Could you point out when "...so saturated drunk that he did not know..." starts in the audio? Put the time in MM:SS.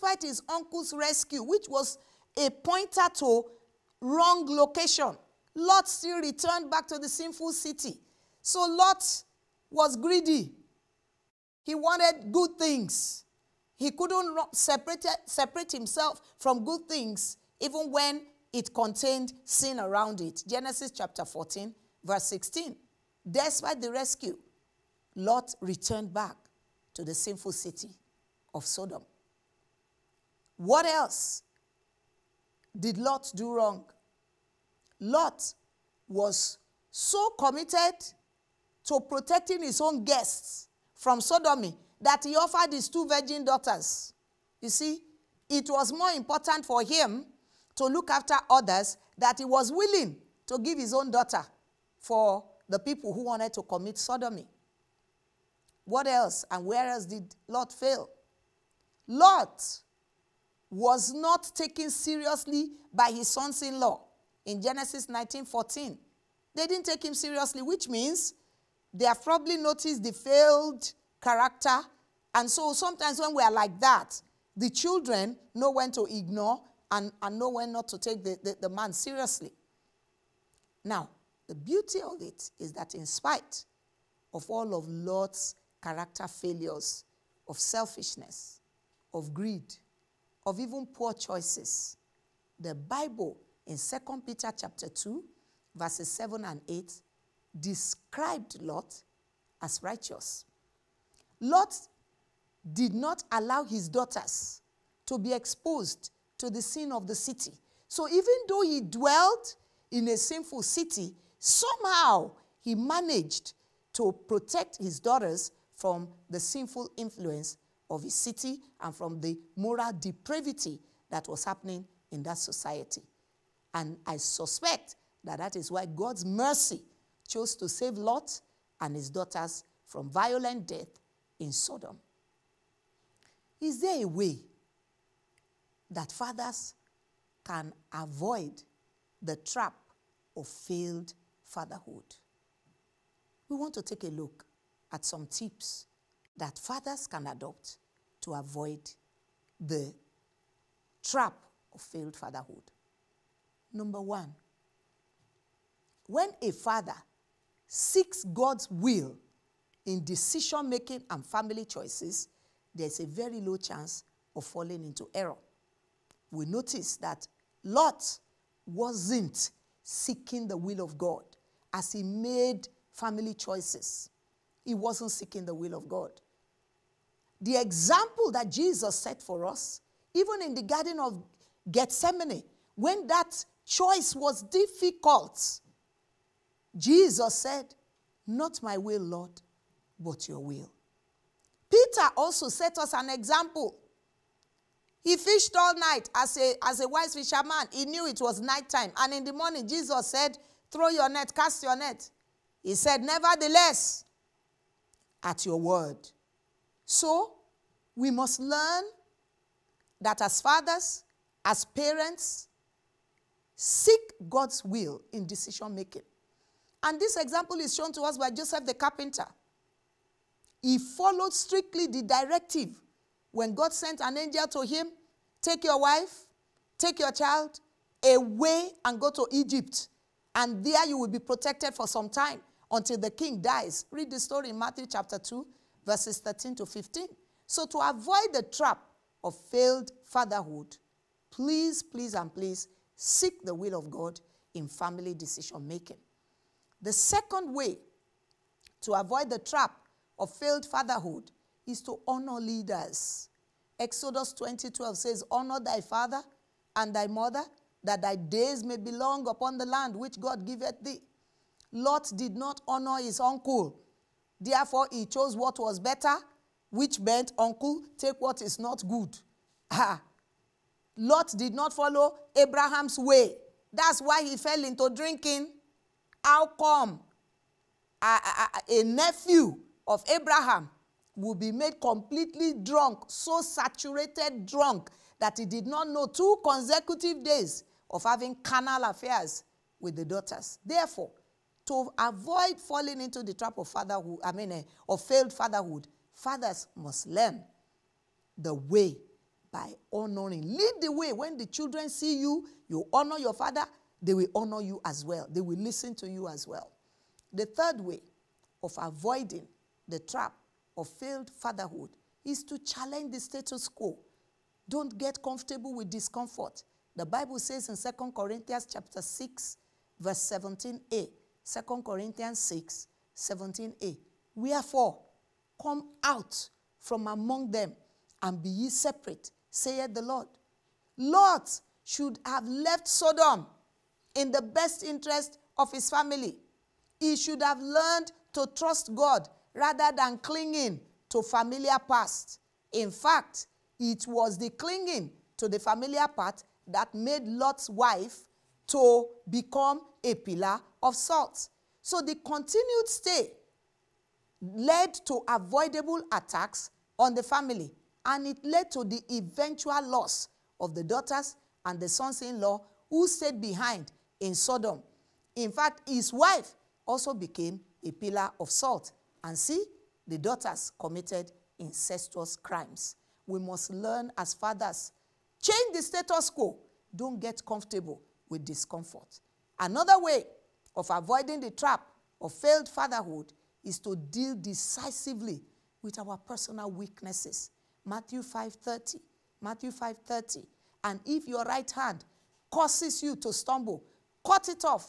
04:43.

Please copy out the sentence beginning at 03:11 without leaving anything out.
Peter also set us an example.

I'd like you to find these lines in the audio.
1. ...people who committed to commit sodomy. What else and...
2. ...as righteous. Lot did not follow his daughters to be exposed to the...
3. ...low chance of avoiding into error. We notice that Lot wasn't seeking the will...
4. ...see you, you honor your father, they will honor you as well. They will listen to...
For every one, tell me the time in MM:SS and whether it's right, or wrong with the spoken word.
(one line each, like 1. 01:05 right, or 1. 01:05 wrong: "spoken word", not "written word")
1. 00:52 wrong: "wanted", not "committed"
2. 01:39 wrong: "allow", not "follow"
3. 02:43 wrong: "falling", not "avoiding"
4. 05:01 right.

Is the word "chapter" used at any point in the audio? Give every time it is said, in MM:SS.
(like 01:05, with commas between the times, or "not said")
00:20, 01:34, 03:54, 05:18.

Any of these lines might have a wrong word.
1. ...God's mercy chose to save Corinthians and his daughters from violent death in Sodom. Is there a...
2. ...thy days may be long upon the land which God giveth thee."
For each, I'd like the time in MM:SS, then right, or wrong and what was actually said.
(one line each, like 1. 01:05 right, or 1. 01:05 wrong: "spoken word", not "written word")
1. 02:05 wrong: "Lot", not "Corinthians"
2. 04:18 right.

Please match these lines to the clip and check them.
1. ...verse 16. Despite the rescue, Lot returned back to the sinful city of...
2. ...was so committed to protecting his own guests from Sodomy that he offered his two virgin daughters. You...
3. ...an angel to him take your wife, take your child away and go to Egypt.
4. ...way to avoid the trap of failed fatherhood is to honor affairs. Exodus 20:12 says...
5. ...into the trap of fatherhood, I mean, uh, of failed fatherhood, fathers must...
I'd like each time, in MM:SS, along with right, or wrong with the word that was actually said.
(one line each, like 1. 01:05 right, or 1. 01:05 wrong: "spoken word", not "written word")
1. 00:22 right
2. 00:36 right
3. 03:44 right
4. 04:07 wrong: "leaders", not "affairs"
5. 04:53 right.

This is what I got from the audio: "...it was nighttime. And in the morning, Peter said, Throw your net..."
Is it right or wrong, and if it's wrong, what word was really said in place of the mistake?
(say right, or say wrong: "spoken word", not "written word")
wrong: "Jesus", not "Peter".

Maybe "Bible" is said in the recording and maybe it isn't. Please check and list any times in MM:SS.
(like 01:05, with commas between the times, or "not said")
01:32, 05:17.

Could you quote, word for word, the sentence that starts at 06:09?
And see, the daughters committed incestuous crimes.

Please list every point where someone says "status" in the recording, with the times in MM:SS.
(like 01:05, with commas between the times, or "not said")
05:13, 06:15.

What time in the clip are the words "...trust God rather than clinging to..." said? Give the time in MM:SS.
05:38.